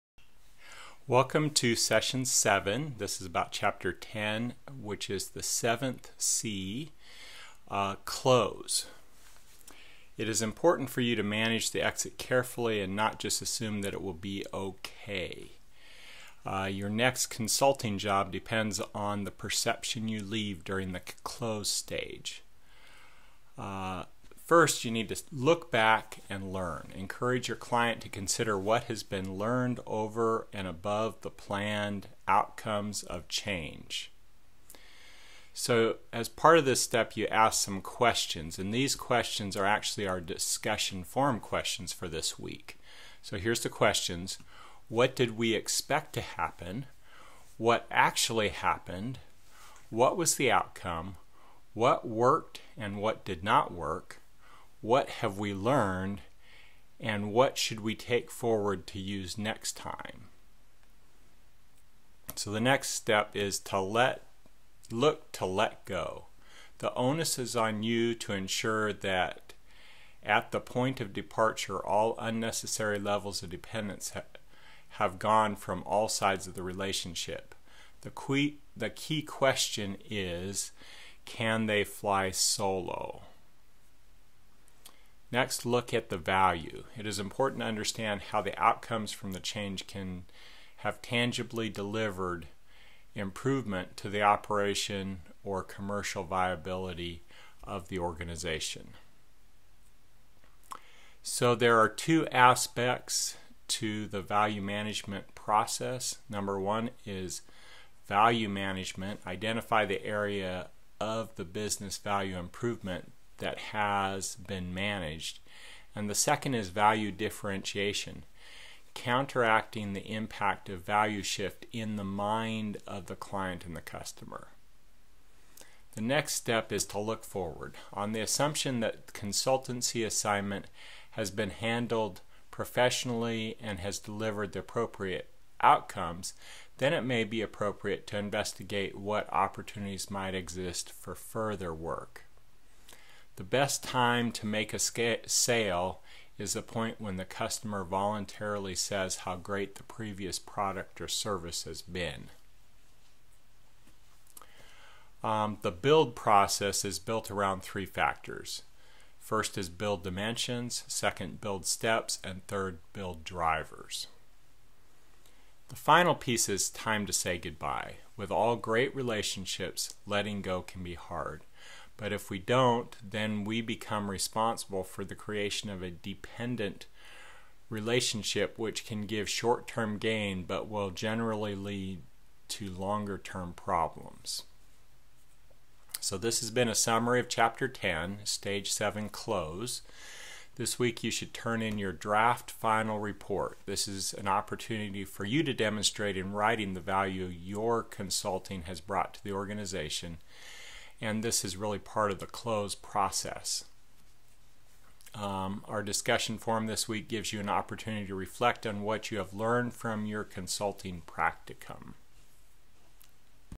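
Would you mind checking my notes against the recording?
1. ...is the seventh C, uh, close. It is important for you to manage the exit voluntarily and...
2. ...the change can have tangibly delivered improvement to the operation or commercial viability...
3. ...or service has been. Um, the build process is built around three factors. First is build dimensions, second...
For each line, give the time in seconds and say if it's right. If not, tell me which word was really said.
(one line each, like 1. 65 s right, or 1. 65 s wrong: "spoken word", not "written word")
1. 5 s wrong: "carefully", not "voluntarily"
2. 89 s right
3. 151 s right.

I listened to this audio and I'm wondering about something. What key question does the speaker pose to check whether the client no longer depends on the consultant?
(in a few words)
Can they fly solo?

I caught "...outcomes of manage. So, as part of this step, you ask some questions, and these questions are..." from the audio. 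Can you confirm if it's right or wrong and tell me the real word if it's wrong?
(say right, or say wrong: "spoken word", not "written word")
wrong: "change", not "manage".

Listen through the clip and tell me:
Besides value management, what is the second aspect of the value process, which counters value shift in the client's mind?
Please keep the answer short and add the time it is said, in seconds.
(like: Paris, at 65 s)
Value differentiation, at 116 s.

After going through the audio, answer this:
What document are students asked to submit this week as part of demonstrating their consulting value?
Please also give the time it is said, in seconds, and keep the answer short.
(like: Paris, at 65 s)
Draft final report, at 191 s.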